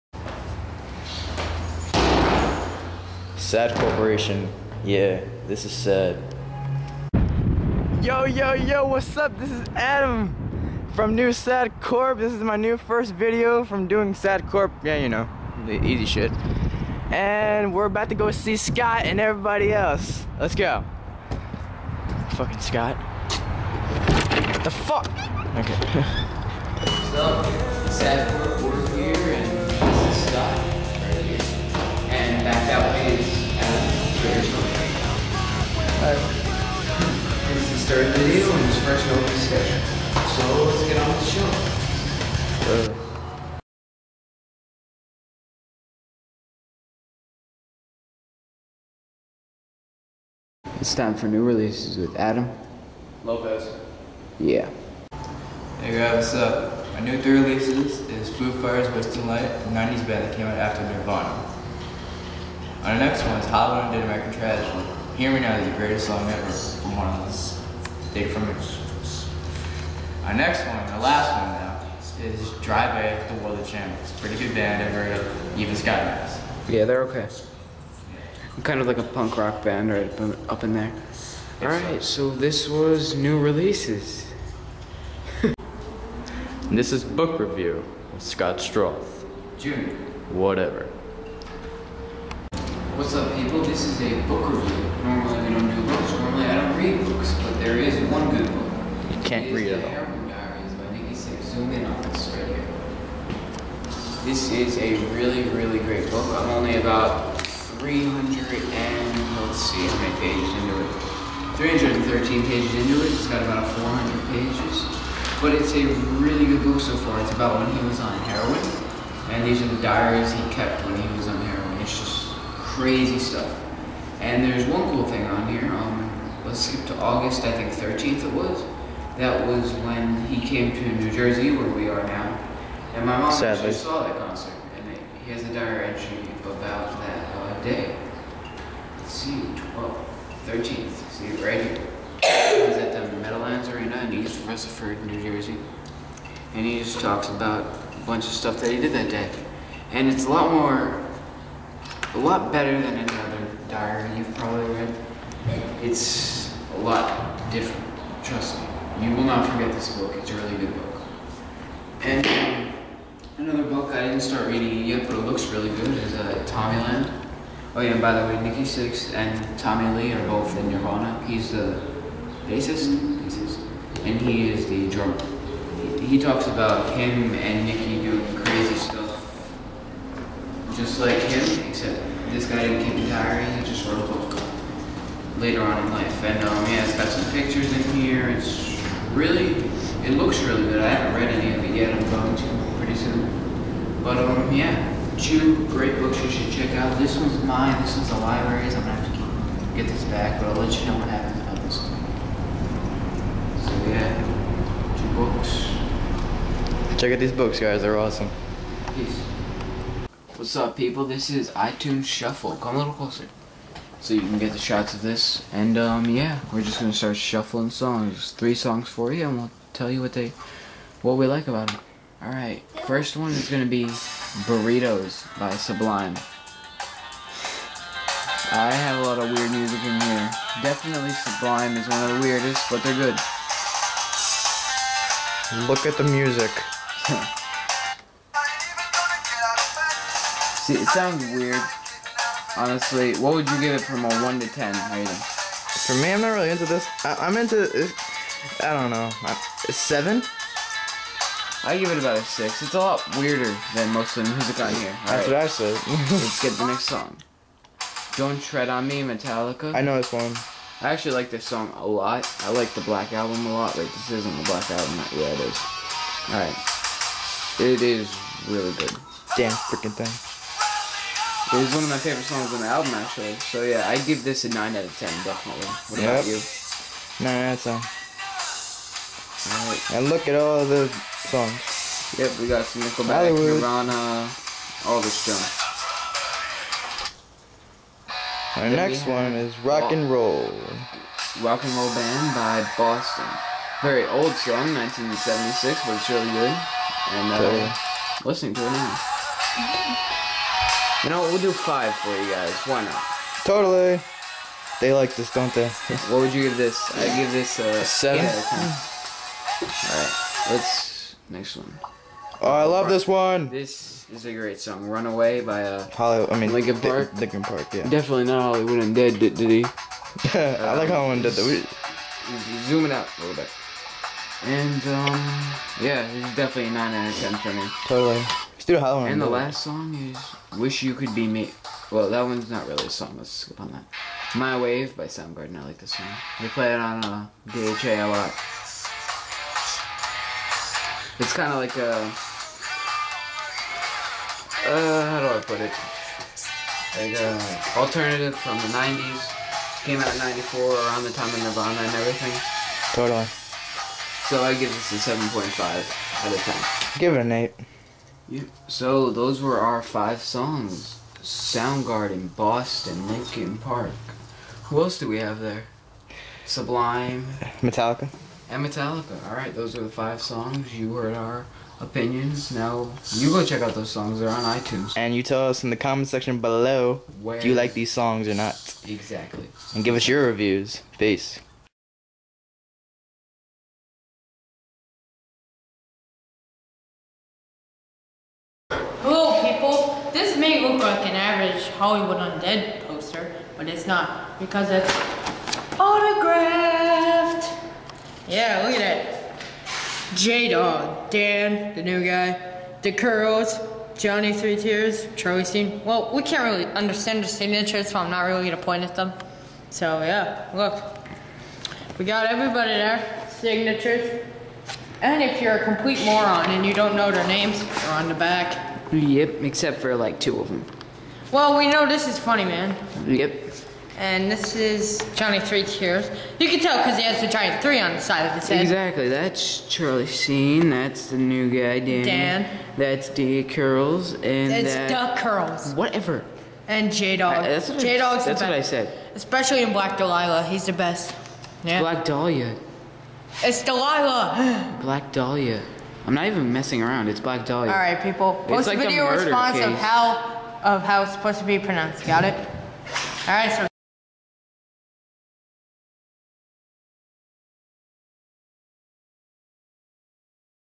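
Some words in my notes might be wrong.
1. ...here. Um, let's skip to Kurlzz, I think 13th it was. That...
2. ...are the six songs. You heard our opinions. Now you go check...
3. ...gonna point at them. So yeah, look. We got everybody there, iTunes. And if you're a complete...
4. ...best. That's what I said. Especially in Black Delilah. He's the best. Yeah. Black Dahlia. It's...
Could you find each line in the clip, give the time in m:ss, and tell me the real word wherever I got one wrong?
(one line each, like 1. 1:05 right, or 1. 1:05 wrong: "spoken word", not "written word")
1. 2:05 wrong: "August", not "Kurlzz"
2. 6:09 wrong: "five", not "six"
3. 6:48 wrong: "signatures", not "iTunes"
4. 7:17 right.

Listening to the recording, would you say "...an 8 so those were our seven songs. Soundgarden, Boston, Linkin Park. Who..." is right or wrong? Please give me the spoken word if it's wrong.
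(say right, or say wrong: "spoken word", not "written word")
wrong: "five", not "seven".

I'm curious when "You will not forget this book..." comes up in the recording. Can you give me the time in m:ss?
2:39.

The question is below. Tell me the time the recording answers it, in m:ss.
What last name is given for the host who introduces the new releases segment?
0:53.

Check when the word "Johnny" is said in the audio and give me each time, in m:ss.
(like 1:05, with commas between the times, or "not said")
6:43, 7:05.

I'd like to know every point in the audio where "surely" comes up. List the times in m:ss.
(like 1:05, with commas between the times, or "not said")
not said.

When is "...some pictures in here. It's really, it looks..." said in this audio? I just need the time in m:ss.
3:07.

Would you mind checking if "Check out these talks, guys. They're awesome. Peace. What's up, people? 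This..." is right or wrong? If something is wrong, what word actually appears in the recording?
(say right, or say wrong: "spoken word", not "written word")
wrong: "books", not "talks".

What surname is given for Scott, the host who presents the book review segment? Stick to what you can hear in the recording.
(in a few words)
Schroth.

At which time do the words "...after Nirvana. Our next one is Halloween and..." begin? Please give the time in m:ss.
1:00.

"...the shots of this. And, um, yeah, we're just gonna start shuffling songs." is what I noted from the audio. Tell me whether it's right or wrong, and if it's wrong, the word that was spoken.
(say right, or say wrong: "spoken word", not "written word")
right.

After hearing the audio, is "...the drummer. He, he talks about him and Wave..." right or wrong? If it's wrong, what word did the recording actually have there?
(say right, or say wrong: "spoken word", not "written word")
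wrong: "Nikki", not "Wave".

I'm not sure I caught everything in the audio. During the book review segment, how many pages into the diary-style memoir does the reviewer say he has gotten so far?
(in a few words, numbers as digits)
313.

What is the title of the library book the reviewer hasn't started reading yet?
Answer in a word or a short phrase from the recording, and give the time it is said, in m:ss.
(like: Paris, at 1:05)
Tommyland, at 2:46.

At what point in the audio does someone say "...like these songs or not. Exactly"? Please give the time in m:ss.
6:17.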